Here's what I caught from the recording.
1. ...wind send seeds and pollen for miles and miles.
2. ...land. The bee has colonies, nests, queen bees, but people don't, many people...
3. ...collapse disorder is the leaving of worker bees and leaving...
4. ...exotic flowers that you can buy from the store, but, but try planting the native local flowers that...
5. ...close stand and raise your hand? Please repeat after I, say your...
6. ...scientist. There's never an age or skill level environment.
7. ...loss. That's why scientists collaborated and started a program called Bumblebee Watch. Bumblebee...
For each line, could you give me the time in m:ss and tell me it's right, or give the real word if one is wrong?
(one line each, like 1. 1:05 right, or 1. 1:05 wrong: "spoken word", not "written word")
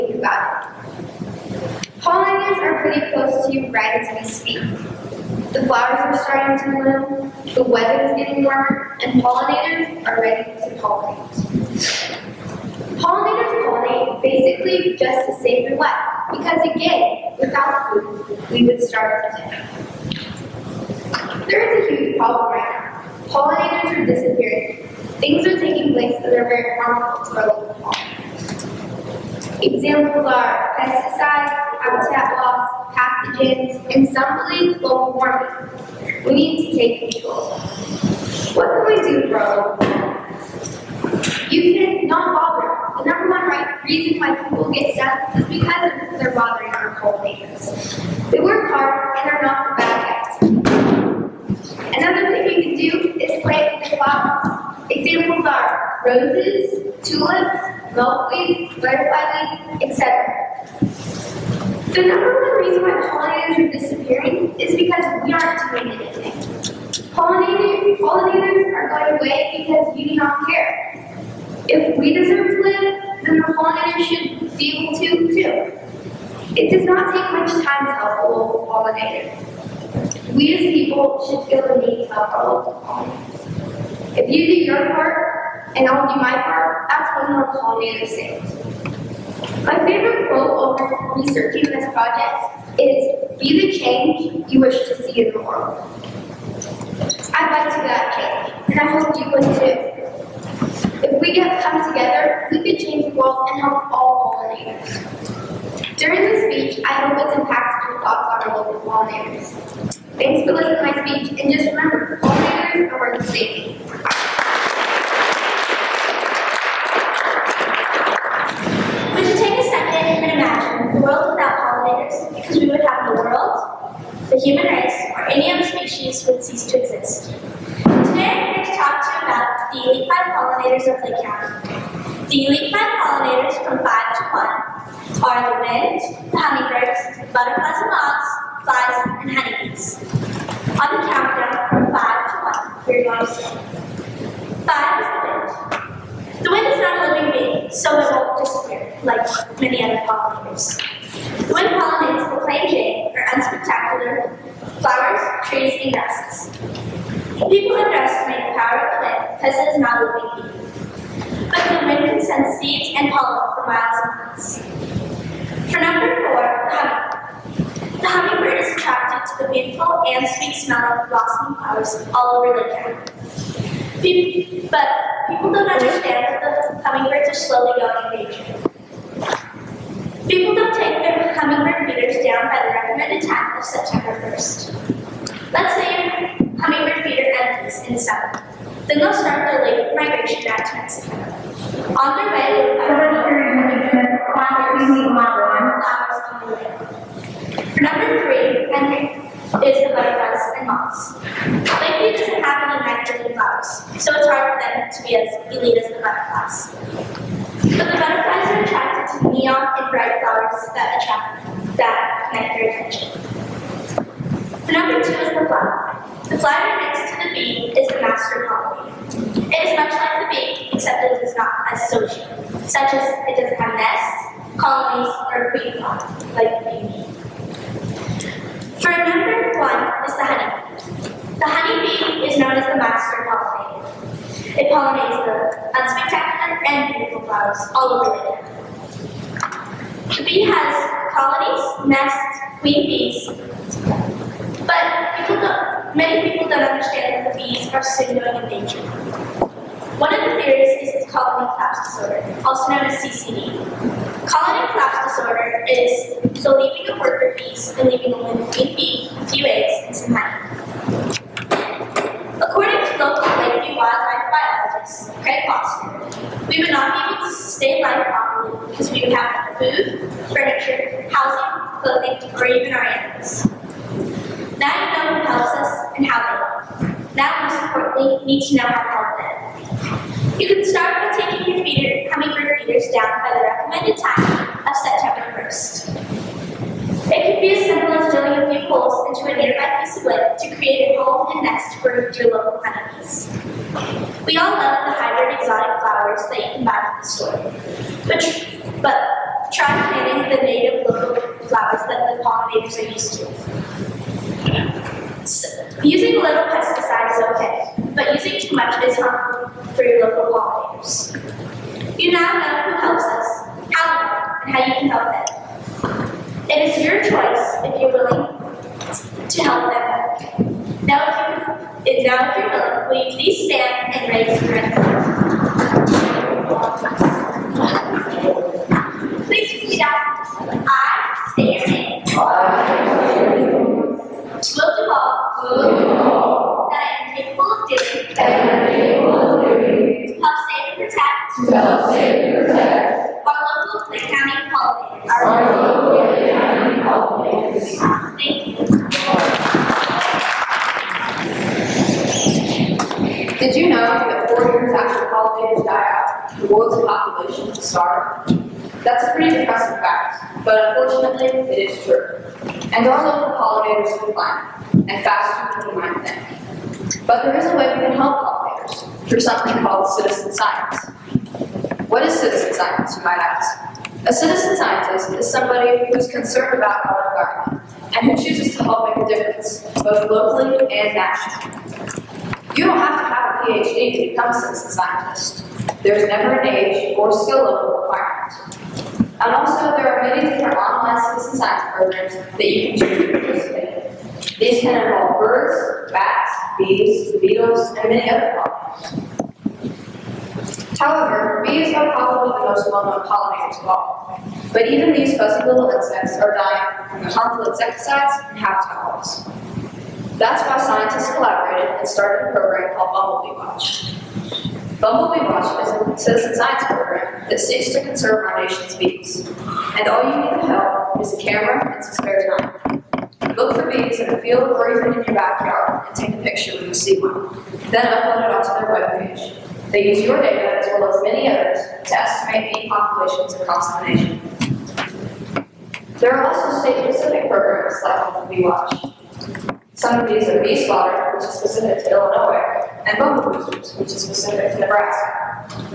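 1. 2:41 right
2. 3:58 right
3. 4:14 right
4. 4:55 right
5. 5:23 wrong: "please", not "close"
6. 6:24 wrong: "requirement", not "environment"
7. 6:48 right.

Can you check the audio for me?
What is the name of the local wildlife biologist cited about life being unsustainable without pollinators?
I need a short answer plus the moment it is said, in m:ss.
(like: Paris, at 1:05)
Craig Foster, at 4:25.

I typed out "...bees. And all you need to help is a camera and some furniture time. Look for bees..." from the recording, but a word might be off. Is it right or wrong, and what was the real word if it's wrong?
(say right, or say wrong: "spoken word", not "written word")
wrong: "spare", not "furniture".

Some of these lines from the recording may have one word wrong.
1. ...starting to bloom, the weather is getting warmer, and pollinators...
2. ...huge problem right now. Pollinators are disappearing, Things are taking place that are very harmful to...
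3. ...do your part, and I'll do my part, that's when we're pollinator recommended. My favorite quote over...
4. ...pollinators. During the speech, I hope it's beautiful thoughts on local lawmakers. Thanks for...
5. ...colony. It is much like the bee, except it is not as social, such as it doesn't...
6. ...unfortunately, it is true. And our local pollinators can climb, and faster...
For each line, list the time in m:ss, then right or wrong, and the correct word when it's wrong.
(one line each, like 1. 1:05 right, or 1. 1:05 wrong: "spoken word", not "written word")
1. 0:06 right
2. 0:22 right
3. 1:24 wrong: "saved", not "recommended"
4. 1:44 wrong: "impactful", not "beautiful"
5. 3:38 right
6. 6:00 right.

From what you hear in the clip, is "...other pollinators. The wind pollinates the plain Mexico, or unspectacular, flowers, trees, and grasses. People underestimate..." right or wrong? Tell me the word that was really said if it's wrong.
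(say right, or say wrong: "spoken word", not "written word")
wrong: "Jane", not "Mexico".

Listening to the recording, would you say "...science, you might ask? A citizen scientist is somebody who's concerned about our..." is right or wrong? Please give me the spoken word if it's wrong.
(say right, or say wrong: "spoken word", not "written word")
right.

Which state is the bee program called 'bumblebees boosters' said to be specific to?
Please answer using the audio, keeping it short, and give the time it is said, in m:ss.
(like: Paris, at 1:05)
Nebraska, at 7:24.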